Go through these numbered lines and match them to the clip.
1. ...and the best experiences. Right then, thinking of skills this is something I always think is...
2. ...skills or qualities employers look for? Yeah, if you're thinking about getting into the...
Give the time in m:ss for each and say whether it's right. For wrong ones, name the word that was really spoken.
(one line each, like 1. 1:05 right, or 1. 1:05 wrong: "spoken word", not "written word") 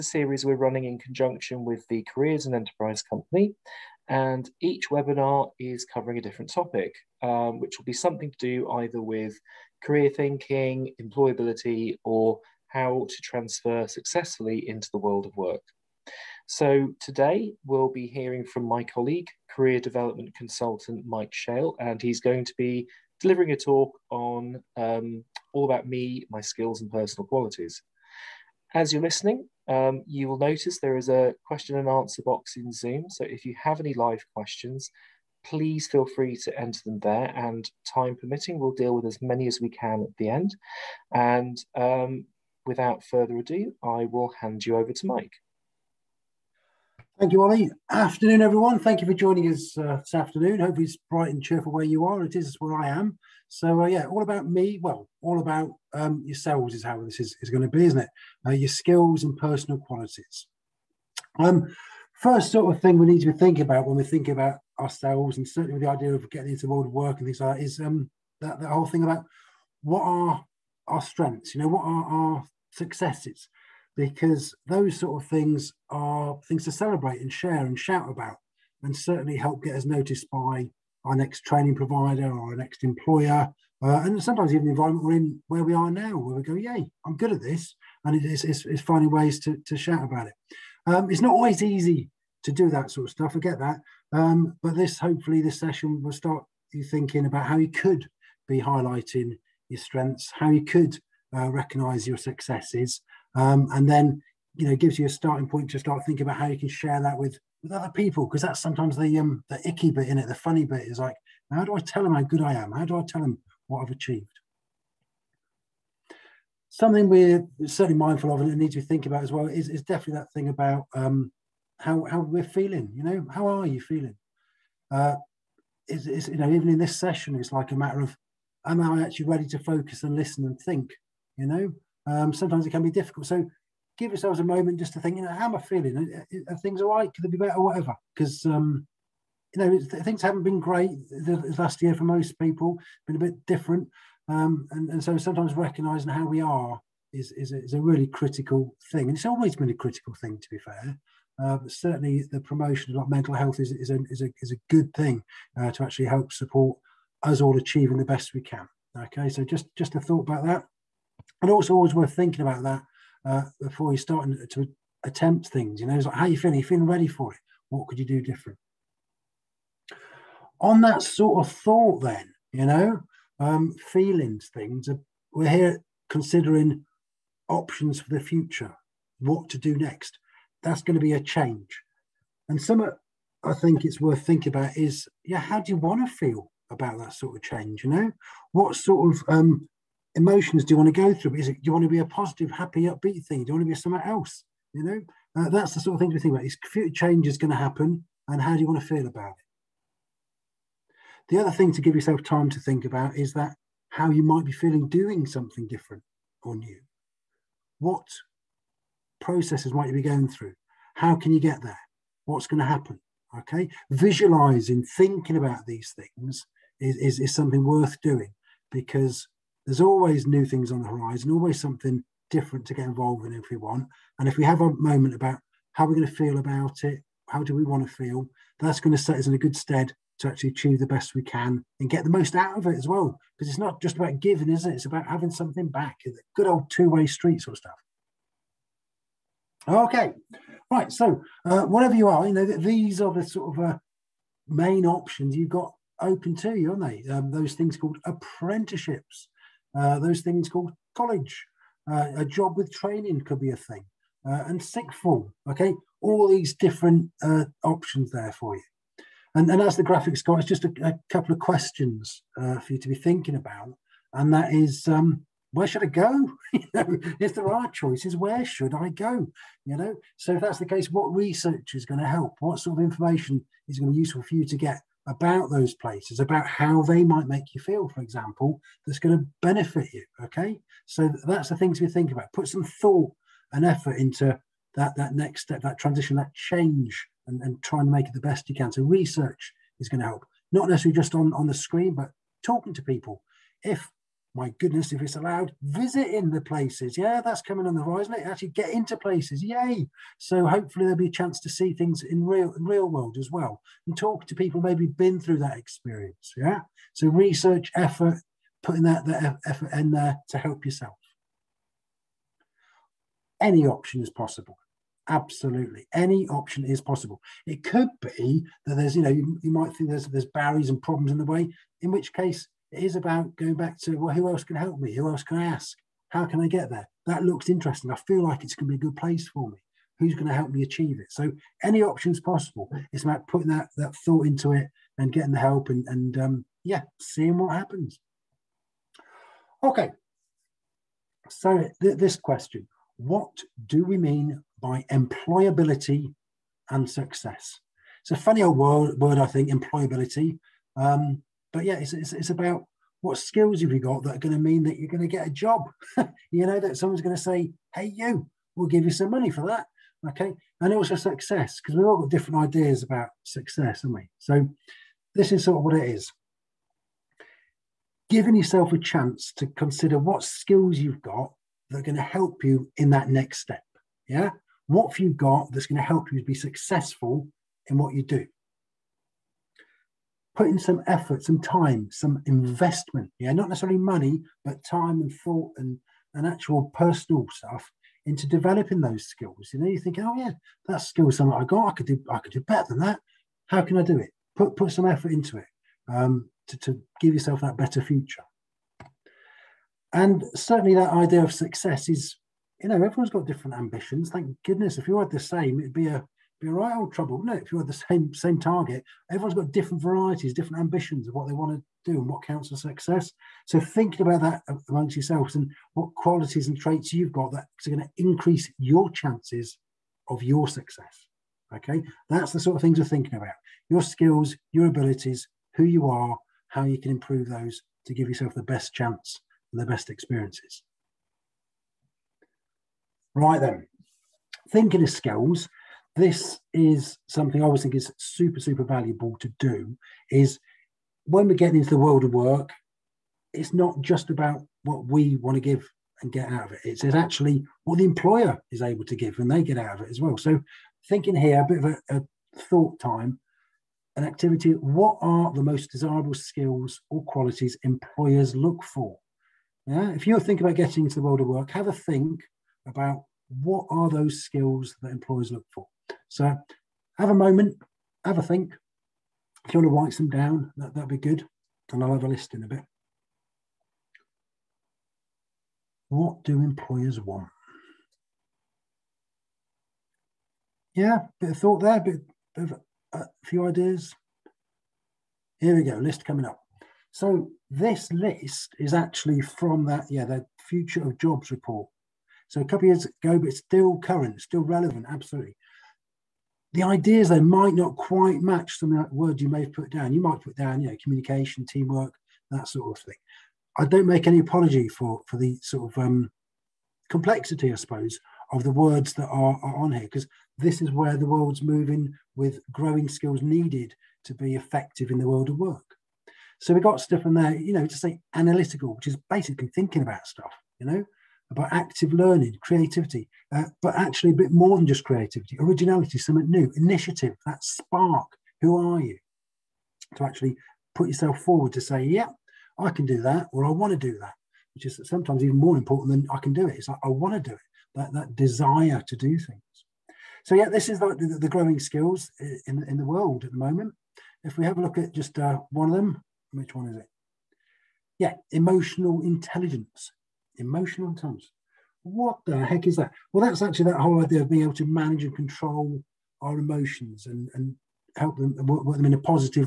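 1. 7:09 right
2. 7:36 right.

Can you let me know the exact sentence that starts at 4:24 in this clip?
And that is, um, where should I go?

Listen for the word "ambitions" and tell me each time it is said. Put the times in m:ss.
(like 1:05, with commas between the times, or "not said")
6:43, 6:50.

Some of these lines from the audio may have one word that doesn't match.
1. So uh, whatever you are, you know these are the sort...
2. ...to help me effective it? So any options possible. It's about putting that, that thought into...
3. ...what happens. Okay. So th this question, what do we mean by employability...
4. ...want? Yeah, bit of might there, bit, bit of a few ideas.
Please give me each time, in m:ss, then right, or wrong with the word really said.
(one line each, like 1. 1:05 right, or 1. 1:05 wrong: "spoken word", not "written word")
1. 4:00 right
2. 5:30 wrong: "achieve", not "effective"
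3. 5:37 right
4. 7:57 wrong: "thought", not "might".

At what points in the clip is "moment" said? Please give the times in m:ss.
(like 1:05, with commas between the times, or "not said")
2:14, 3:44, 7:47, 9:03.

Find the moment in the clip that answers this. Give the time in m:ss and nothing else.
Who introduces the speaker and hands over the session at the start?
0:47.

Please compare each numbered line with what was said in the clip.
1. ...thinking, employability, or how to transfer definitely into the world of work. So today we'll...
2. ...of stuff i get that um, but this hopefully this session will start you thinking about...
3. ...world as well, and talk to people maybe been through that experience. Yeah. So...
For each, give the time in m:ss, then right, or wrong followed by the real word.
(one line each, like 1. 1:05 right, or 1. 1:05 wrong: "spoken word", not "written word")
1. 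0:10 wrong: "successfully", not "definitely"
2. 1:33 right
3. 5:02 right.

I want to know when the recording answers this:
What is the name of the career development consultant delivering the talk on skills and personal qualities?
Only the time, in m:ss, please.
0:21.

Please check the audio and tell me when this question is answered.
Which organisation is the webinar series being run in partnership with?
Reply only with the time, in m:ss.
0:02.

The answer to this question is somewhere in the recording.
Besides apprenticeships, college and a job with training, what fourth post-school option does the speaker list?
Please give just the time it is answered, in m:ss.
4:14.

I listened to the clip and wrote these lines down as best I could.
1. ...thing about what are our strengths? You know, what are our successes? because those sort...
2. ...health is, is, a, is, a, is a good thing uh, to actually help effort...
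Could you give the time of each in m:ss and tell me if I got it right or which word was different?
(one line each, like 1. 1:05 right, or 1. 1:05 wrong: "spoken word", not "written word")
1. 1:08 right
2. 2:33 wrong: "support", not "effort".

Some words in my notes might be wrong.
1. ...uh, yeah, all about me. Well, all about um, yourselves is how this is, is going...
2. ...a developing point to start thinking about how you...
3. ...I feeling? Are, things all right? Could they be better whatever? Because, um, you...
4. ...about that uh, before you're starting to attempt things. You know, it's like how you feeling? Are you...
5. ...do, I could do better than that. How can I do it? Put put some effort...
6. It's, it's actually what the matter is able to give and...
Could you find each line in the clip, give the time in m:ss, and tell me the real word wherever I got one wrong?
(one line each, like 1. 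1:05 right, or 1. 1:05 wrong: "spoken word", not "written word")
1. 0:53 right
2. 1:45 wrong: "starting", not "developing"
3. 2:15 right
4. 2:42 right
5. 6:31 right
6. 7:26 wrong: "employer", not "matter".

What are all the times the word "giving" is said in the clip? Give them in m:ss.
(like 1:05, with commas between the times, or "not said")
3:54, 6:08.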